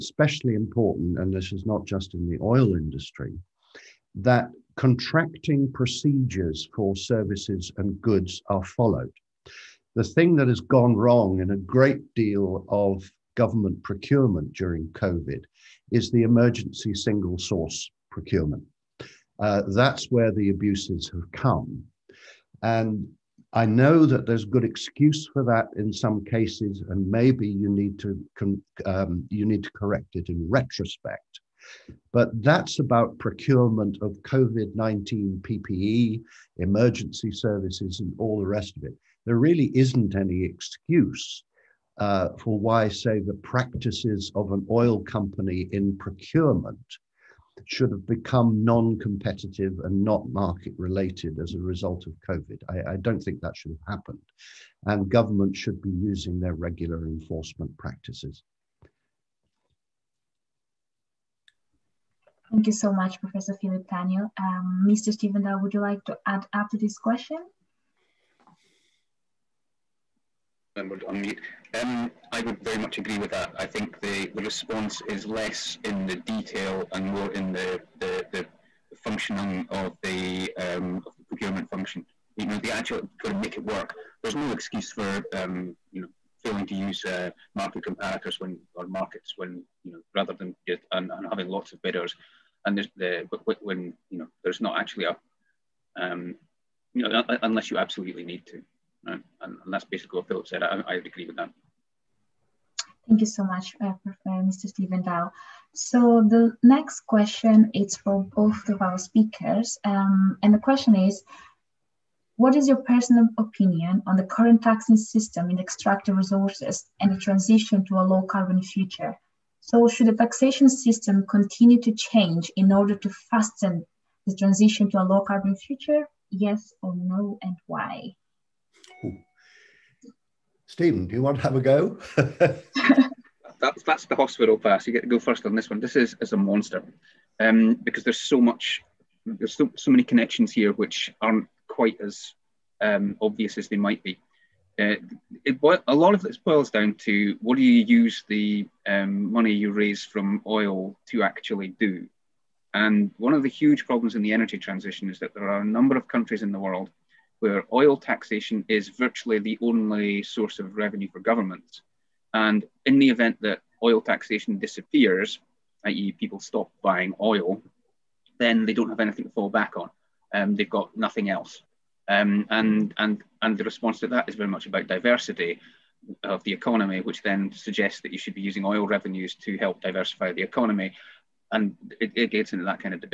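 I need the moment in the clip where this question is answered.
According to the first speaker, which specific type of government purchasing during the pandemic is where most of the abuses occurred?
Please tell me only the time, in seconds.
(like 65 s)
16 s.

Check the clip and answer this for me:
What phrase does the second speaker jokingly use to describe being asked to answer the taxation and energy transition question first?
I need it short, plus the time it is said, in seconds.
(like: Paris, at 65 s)
the hospital pass, at 134 s.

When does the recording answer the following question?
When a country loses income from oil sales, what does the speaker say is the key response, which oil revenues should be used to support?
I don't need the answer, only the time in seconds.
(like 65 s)
174 s.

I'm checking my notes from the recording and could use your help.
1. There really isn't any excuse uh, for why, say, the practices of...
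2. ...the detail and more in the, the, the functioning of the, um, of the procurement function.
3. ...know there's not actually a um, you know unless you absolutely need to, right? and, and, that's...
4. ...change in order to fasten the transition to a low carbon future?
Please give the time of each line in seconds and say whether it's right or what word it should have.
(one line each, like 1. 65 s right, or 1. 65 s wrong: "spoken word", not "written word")
1. 39 s right
2. 76 s right
3. 94 s right
4. 121 s right.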